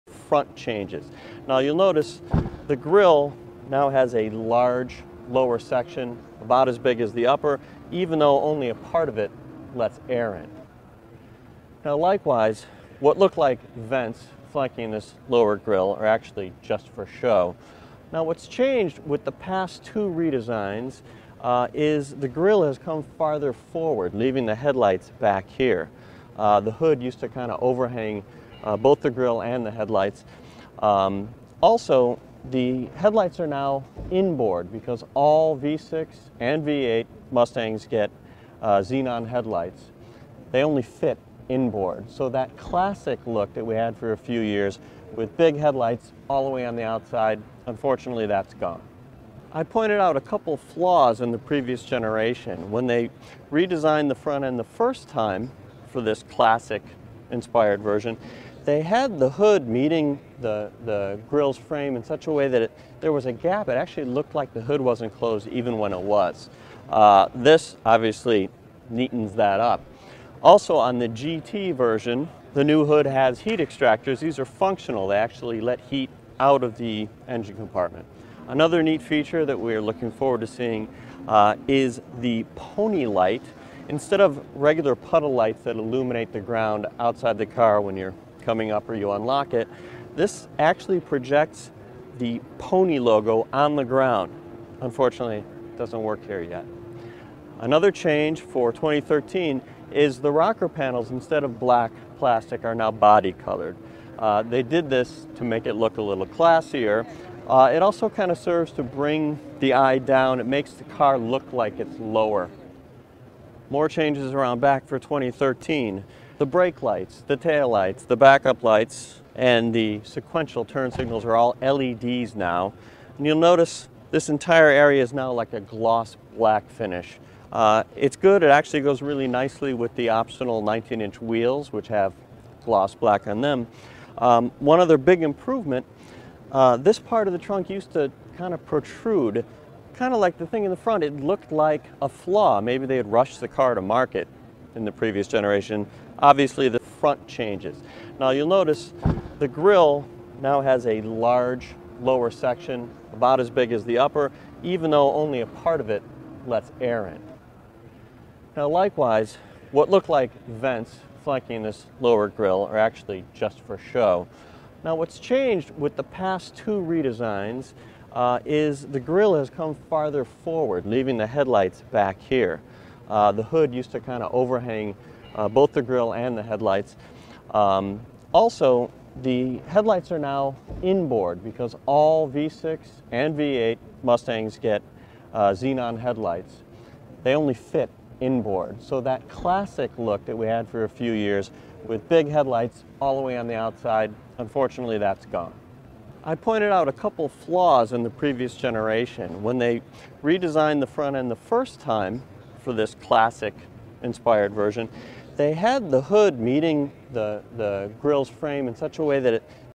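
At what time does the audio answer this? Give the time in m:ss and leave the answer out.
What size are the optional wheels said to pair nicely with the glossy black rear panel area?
2:10.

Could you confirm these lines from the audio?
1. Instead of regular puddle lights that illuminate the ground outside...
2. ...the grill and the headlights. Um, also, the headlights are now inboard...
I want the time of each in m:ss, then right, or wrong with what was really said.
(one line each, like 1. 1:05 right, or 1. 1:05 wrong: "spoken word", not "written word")
1. 1:23 right
2. 2:55 right.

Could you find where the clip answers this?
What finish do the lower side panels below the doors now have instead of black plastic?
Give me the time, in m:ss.
1:42.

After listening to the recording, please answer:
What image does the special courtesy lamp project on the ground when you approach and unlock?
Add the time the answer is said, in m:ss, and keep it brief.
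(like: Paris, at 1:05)
The pony logo, at 1:32.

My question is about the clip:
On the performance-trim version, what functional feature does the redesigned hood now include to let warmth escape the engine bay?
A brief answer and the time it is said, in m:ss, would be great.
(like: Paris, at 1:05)
Heat extractors, at 1:13.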